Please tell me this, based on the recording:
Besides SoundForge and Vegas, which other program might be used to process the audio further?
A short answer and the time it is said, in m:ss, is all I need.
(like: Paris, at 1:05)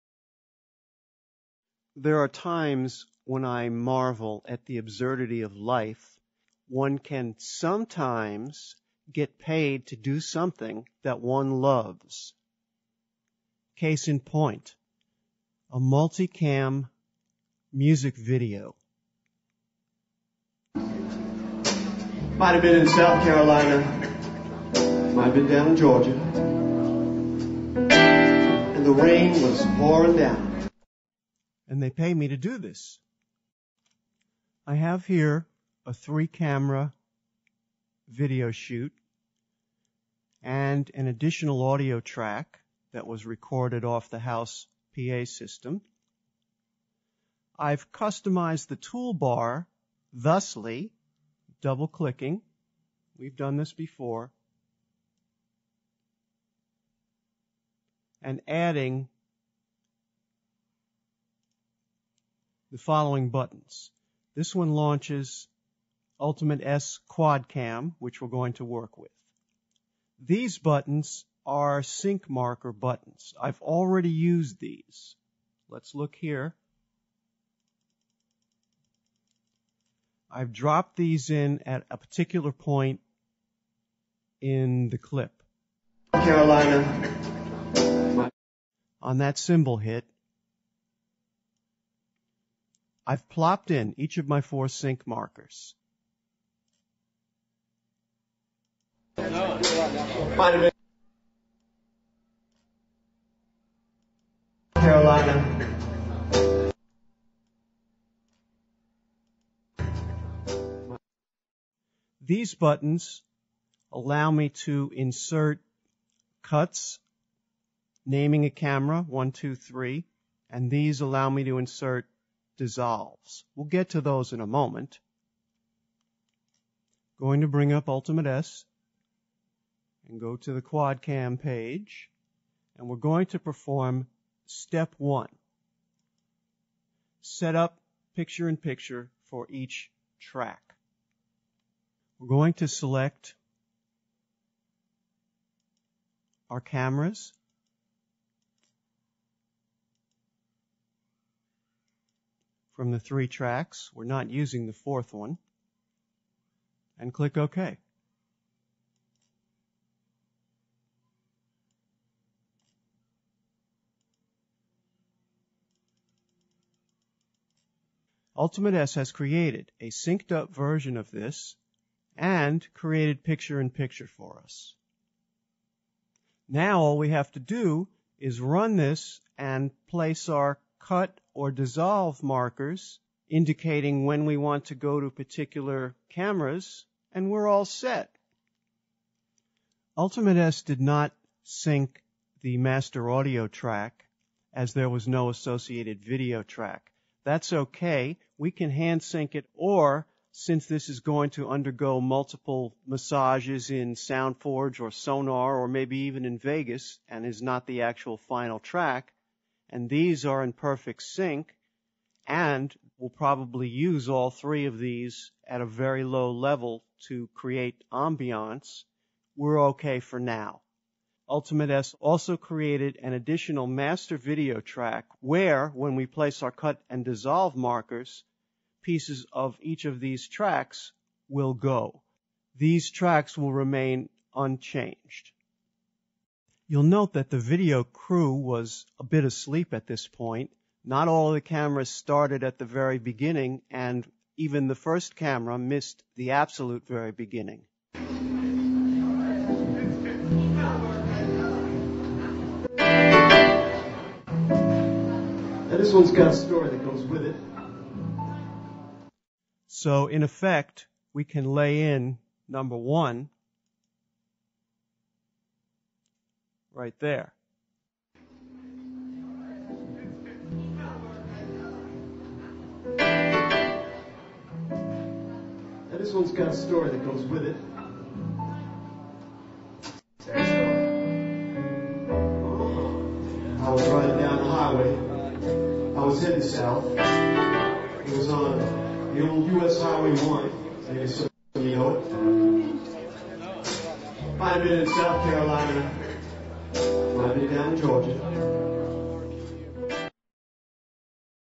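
Sonar, at 3:24.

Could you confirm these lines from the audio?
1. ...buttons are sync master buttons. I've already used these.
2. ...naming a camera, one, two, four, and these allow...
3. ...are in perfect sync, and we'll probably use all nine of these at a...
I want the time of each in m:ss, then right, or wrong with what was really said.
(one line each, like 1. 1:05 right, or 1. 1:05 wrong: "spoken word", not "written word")
1. 1:10 wrong: "marker", not "master"
2. 1:58 wrong: "three", not "four"
3. 3:30 wrong: "three", not "nine".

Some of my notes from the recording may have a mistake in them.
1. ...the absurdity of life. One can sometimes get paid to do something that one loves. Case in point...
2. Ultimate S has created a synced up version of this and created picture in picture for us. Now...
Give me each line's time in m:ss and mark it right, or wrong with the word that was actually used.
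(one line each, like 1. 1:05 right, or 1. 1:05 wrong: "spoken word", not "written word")
1. 0:04 right
2. 2:48 right.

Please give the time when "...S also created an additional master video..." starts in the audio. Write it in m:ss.
3:41.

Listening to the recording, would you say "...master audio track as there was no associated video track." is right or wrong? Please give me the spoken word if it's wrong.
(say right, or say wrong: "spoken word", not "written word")
right.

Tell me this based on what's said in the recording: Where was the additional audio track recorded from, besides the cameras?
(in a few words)
house PA system.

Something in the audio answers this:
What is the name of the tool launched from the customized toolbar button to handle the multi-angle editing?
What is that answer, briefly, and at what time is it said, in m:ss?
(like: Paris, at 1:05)
Ultimate S Quad Cam, at 1:06.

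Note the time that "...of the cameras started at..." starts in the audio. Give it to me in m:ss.
4:01.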